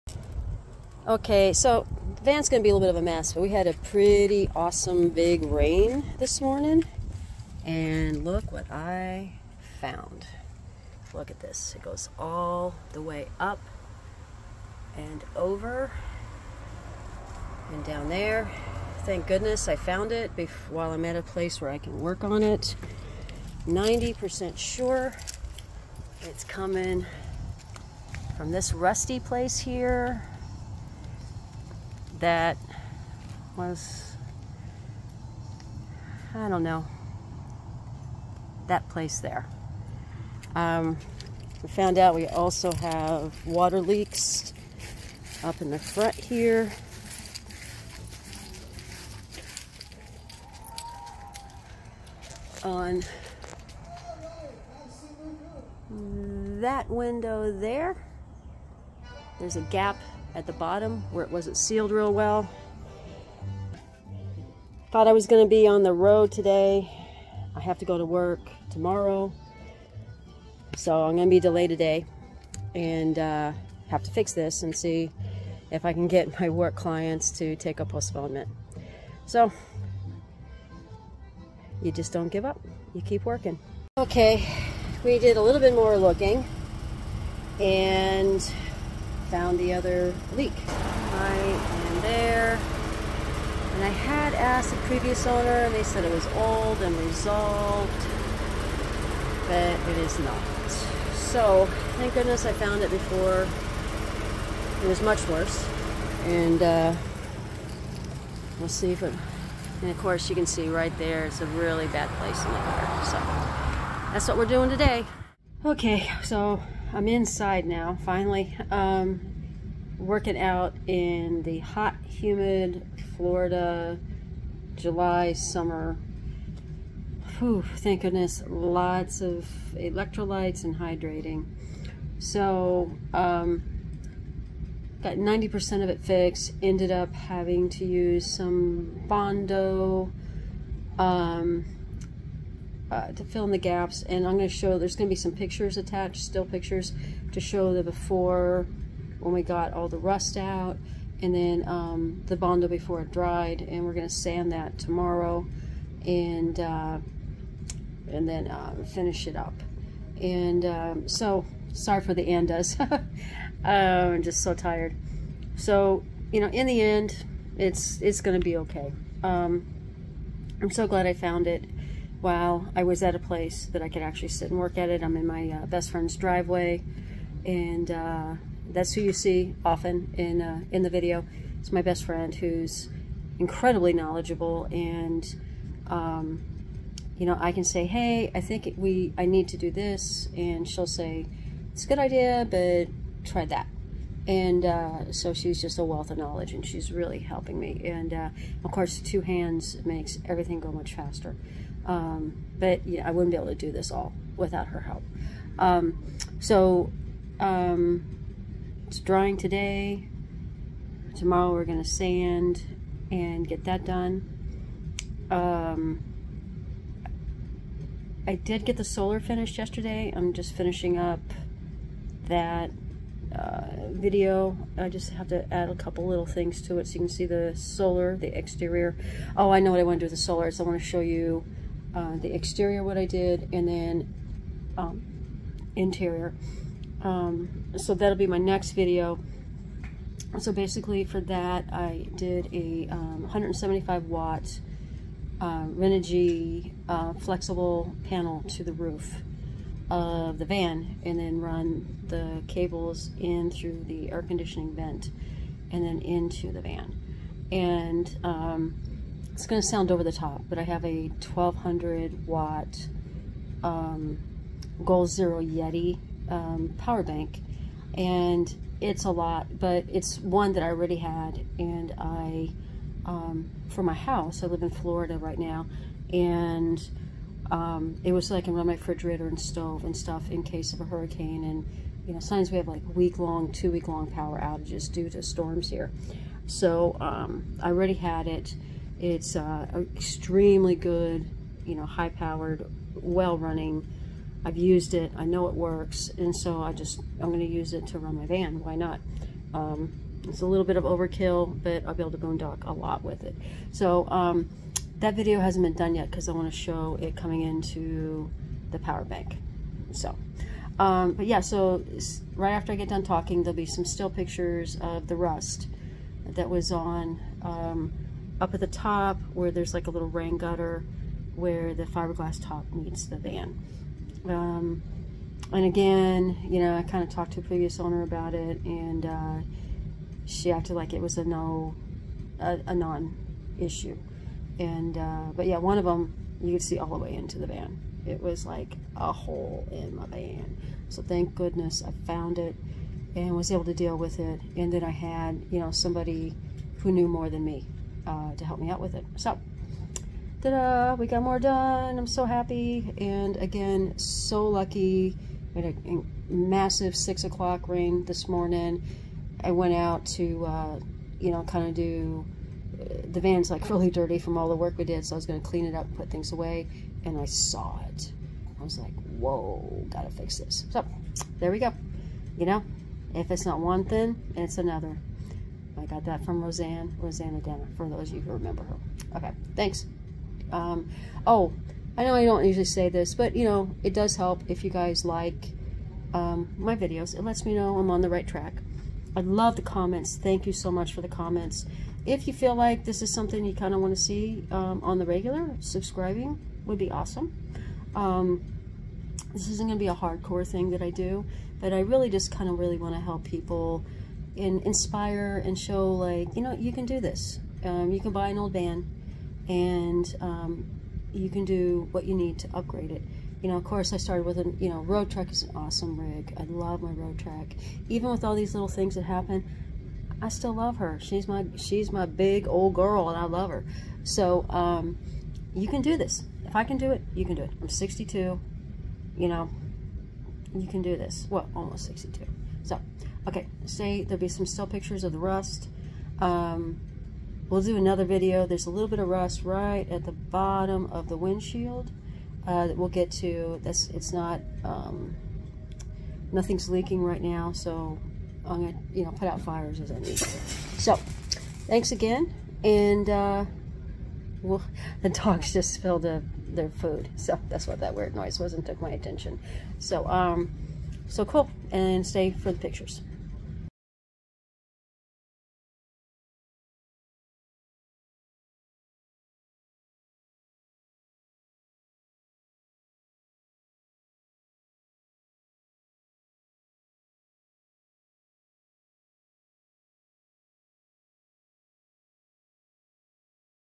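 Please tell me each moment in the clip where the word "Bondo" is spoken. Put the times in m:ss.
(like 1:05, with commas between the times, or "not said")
2:19, 2:32.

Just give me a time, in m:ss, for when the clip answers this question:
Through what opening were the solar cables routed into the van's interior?
4:14.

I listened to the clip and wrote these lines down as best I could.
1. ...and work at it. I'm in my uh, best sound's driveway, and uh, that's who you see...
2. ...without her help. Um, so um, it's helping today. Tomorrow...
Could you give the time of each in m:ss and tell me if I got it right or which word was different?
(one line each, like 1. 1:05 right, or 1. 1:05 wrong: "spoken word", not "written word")
1. 2:54 wrong: "friend", not "sound"
2. 3:24 wrong: "drying", not "helping".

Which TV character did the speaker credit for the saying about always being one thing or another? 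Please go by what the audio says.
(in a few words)
Roseanne Roseannadanna.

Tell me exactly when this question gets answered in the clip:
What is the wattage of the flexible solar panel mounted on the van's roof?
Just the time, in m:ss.
4:02.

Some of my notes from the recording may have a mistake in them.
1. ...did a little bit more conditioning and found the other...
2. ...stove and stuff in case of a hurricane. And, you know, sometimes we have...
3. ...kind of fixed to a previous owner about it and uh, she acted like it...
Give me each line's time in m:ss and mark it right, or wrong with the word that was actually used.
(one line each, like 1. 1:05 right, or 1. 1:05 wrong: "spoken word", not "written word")
1. 1:25 wrong: "looking", not "conditioning"
2. 4:39 right
3. 5:26 wrong: "talked", not "fixed".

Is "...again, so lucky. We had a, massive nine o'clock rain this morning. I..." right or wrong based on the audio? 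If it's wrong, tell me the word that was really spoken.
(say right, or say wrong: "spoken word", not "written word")
wrong: "six", not "nine".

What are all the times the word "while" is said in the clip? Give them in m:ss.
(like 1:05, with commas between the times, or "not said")
0:20, 2:52.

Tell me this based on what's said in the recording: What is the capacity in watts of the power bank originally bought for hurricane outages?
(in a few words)
1200 watts.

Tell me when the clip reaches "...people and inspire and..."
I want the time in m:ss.
6:43.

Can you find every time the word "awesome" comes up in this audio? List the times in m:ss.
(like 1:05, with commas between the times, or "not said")
0:04, 6:36, 6:55.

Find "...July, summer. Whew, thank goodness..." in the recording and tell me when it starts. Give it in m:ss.
2:04.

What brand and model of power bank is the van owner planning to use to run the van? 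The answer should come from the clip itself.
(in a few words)
Goal Zero Yeti.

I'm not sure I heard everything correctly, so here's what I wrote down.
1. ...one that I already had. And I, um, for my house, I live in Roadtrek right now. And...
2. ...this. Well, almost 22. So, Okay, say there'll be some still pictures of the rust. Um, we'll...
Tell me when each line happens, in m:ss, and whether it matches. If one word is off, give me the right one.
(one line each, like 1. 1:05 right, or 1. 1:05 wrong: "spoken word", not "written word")
1. 4:30 wrong: "Florida", not "Roadtrek"
2. 7:10 wrong: "62", not "22".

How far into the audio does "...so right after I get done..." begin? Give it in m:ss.
5:11.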